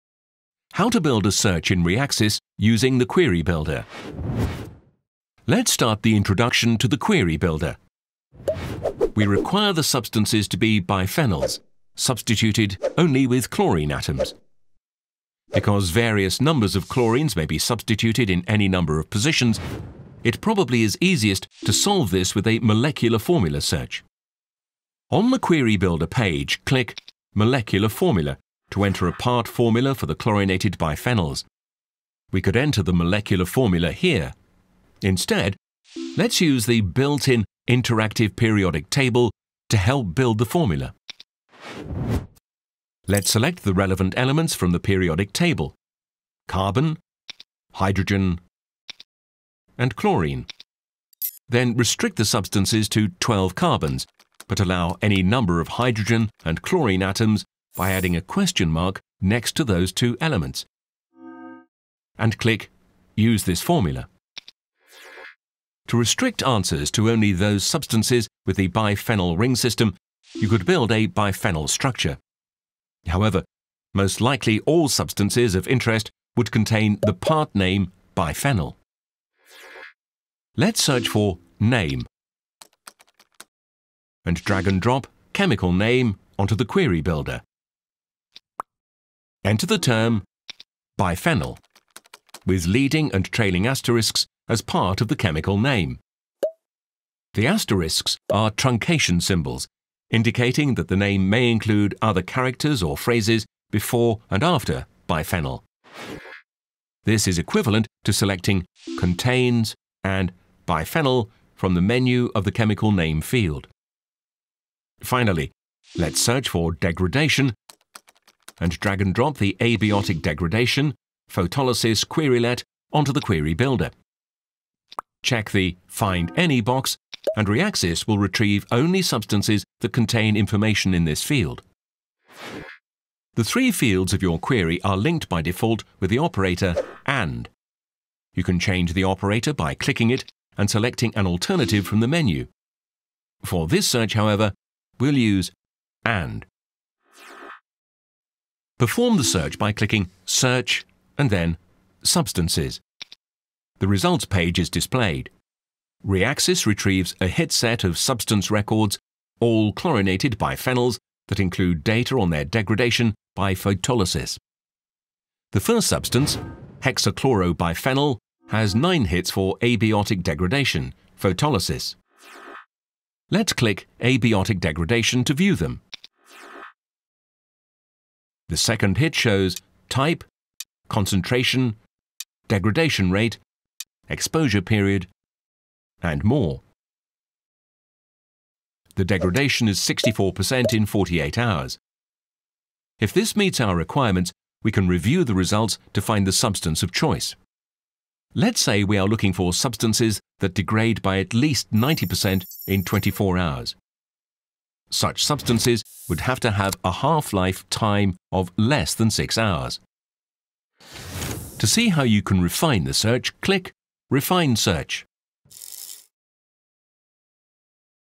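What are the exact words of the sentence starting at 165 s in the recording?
The first substance, hexachlorobiphenyl, has 9 hits for abiotic degradation, photolysis.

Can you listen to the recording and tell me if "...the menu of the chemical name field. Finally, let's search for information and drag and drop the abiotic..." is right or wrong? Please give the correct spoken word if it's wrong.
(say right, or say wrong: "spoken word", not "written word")
wrong: "degradation", not "information".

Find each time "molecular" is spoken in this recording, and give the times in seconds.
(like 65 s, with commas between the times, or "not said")
22 s, 27 s, 32 s.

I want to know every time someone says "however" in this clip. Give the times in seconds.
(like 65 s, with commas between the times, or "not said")
73 s, 144 s.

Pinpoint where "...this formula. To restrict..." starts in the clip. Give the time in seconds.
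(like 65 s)
63 s.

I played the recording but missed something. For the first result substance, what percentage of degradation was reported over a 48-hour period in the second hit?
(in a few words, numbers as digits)
64%.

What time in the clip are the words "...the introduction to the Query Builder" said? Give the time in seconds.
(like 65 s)
6 s.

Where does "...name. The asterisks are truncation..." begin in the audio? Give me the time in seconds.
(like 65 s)
95 s.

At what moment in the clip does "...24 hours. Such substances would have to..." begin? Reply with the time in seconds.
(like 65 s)
202 s.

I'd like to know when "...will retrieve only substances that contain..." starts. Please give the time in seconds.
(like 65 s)
128 s.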